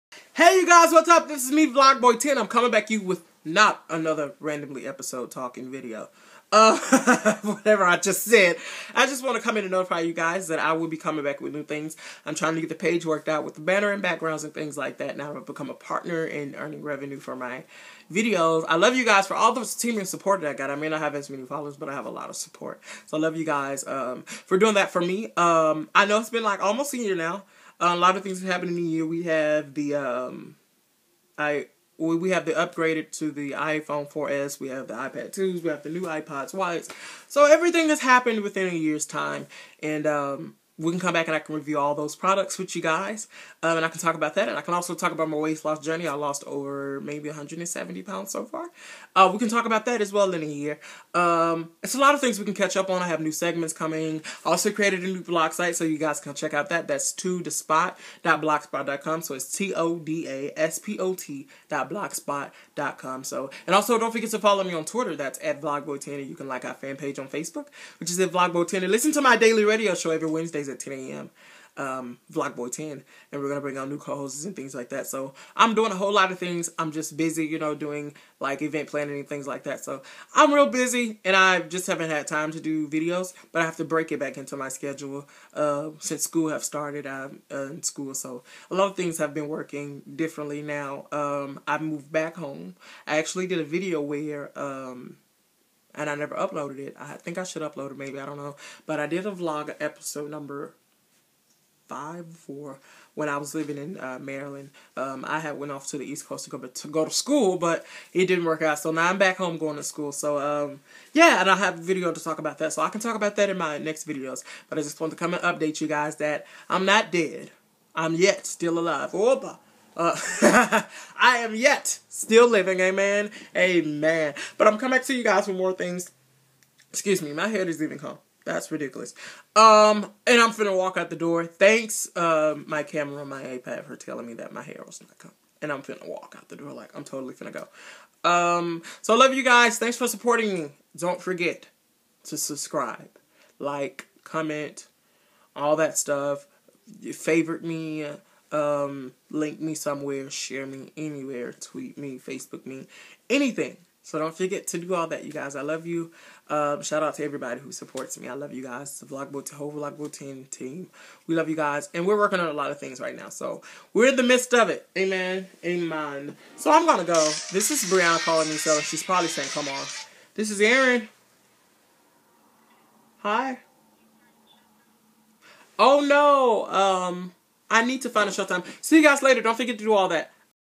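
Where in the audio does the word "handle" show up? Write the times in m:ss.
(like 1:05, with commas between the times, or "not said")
not said.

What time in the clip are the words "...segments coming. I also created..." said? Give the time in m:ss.
0:53.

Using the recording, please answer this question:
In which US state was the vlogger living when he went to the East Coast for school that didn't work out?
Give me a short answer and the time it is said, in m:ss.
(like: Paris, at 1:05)
Maryland, at 1:44.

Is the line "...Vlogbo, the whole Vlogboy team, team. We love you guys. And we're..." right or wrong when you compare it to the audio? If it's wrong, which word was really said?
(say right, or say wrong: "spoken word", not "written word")
right.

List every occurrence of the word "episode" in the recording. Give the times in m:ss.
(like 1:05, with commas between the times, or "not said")
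0:04, 1:39.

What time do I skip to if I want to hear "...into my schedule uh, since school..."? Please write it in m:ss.
1:24.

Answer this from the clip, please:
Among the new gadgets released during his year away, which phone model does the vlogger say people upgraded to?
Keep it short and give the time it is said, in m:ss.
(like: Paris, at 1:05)
iPhone 4S, at 0:33.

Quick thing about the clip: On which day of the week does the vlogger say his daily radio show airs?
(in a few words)
Wednesdays.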